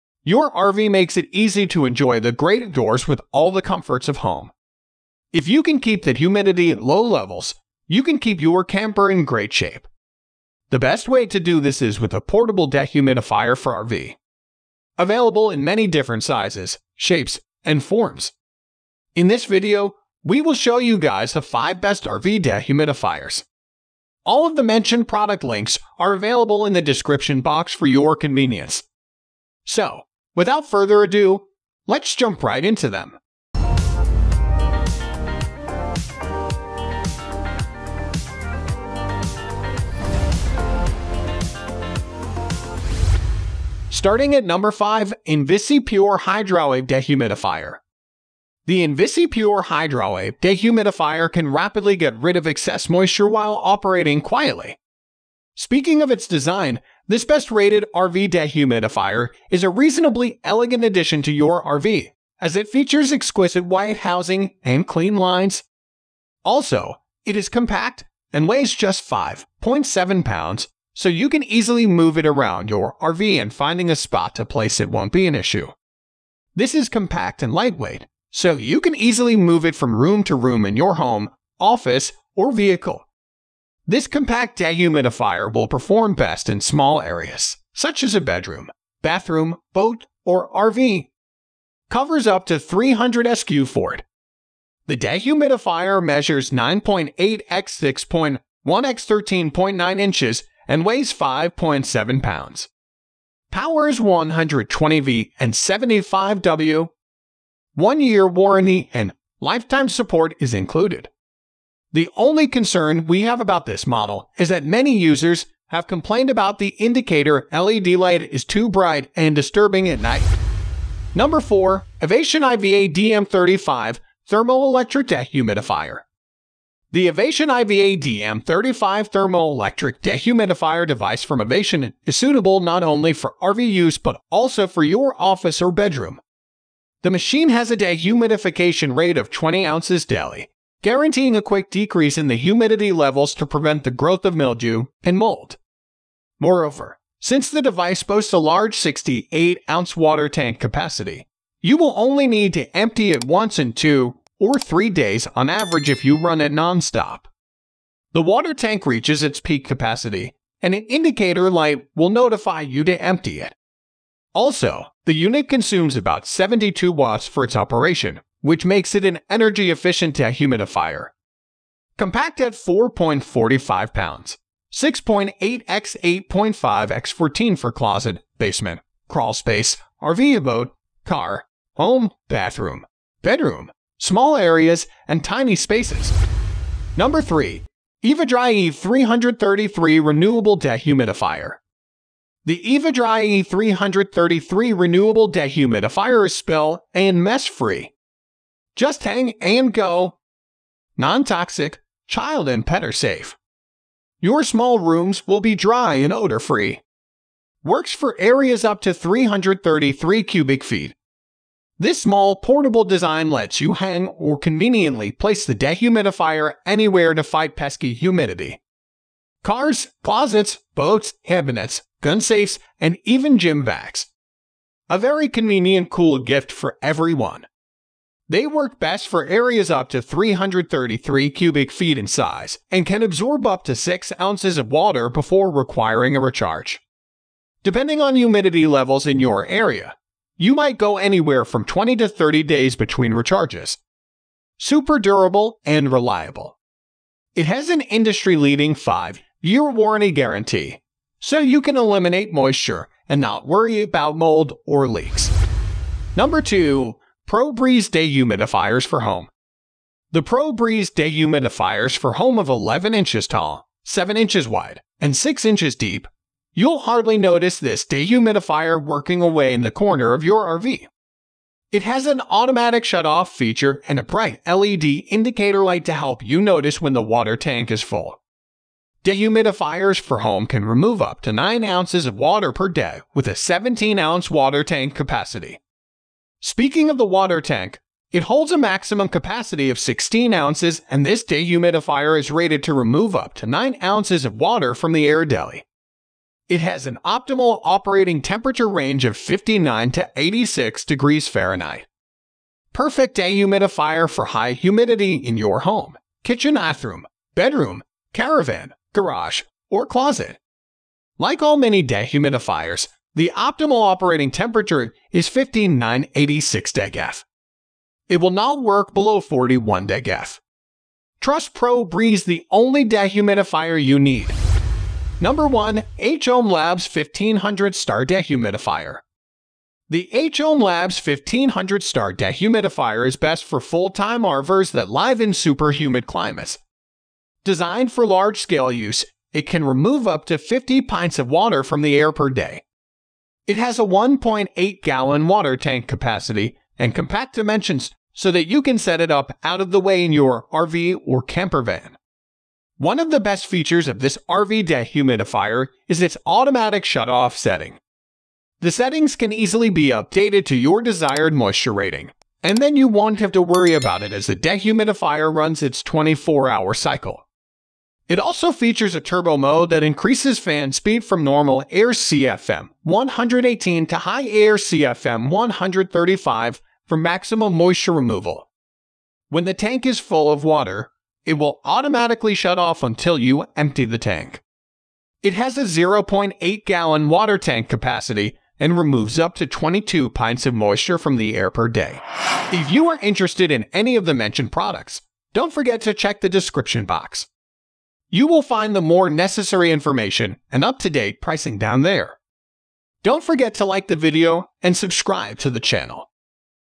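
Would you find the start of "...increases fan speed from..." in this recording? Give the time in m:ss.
6:09.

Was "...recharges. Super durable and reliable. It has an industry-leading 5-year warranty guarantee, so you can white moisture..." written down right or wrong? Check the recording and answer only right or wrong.
wrong.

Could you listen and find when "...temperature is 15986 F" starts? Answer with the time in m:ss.
5:14.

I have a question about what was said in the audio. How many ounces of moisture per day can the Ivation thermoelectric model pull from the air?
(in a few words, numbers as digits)
20 ounces.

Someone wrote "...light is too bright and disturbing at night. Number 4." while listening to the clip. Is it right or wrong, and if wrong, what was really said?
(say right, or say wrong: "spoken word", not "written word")
right.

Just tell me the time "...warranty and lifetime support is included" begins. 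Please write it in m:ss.
1:48.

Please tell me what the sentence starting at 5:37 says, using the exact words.
Designed for large-scale use, it can remove up to 50 pints of water from the air per day.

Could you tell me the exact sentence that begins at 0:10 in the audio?
The best way to do this is with a portable dehumidifier for RV.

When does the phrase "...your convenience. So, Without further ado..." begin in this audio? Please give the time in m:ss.
0:27.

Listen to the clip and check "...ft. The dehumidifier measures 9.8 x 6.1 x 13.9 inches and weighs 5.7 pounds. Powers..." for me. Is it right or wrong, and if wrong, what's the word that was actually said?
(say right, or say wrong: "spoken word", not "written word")
right.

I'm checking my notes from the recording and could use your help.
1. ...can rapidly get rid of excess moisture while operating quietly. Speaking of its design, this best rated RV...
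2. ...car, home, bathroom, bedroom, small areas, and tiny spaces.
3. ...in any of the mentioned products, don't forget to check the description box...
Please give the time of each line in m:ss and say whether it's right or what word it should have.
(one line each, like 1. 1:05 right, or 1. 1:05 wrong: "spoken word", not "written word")
1. 0:51 right
2. 3:01 right
3. 6:33 right.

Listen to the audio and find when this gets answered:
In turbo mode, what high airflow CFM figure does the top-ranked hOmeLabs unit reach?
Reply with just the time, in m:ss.
6:15.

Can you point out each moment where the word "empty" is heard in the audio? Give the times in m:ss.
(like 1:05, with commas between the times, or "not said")
2:32, 2:43, 6:23.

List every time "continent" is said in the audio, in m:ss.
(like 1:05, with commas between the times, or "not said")
not said.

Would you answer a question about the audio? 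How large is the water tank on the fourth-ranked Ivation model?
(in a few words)
68 ounces.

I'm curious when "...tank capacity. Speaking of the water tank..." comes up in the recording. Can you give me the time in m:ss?
4:44.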